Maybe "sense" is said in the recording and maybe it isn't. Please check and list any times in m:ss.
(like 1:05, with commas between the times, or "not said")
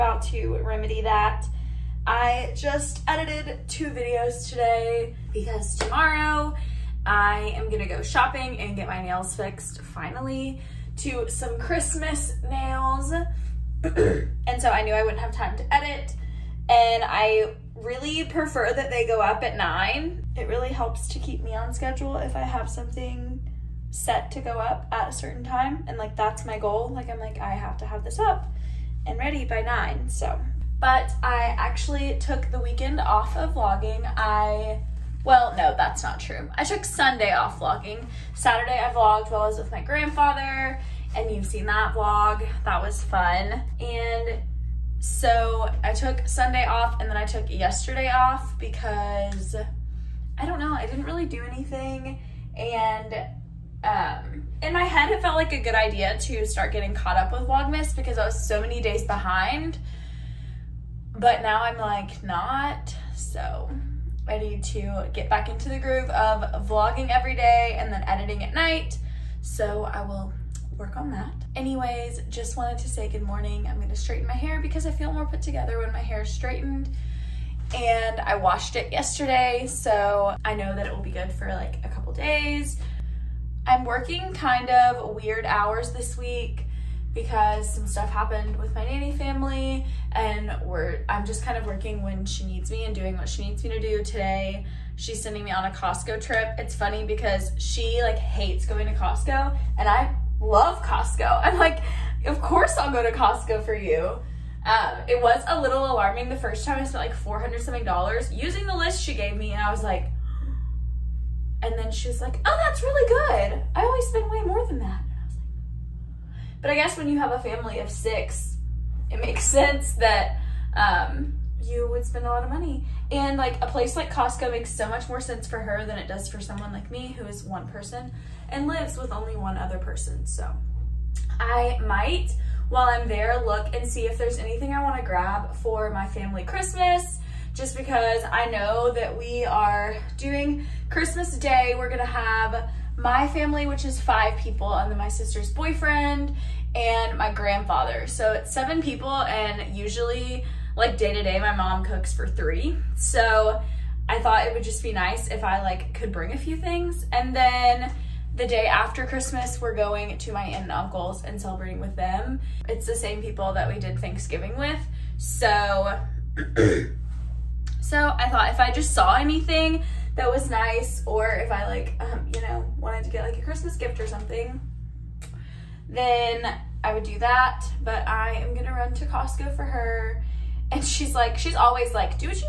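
1:59, 2:05.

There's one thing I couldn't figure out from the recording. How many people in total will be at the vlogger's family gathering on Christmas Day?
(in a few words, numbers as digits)
7.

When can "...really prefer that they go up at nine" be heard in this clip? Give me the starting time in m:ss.
0:17.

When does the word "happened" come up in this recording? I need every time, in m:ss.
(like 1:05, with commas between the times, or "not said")
1:28.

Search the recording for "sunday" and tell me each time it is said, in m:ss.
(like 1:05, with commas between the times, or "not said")
0:36, 0:46.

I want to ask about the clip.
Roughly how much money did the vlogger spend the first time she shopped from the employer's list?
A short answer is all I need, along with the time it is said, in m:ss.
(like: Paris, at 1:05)
400 something dollars, at 1:47.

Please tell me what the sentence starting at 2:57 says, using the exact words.
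But I am gonna run to Costco for her.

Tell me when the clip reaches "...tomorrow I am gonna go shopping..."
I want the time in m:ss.
0:05.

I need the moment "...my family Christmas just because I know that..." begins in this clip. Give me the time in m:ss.
2:15.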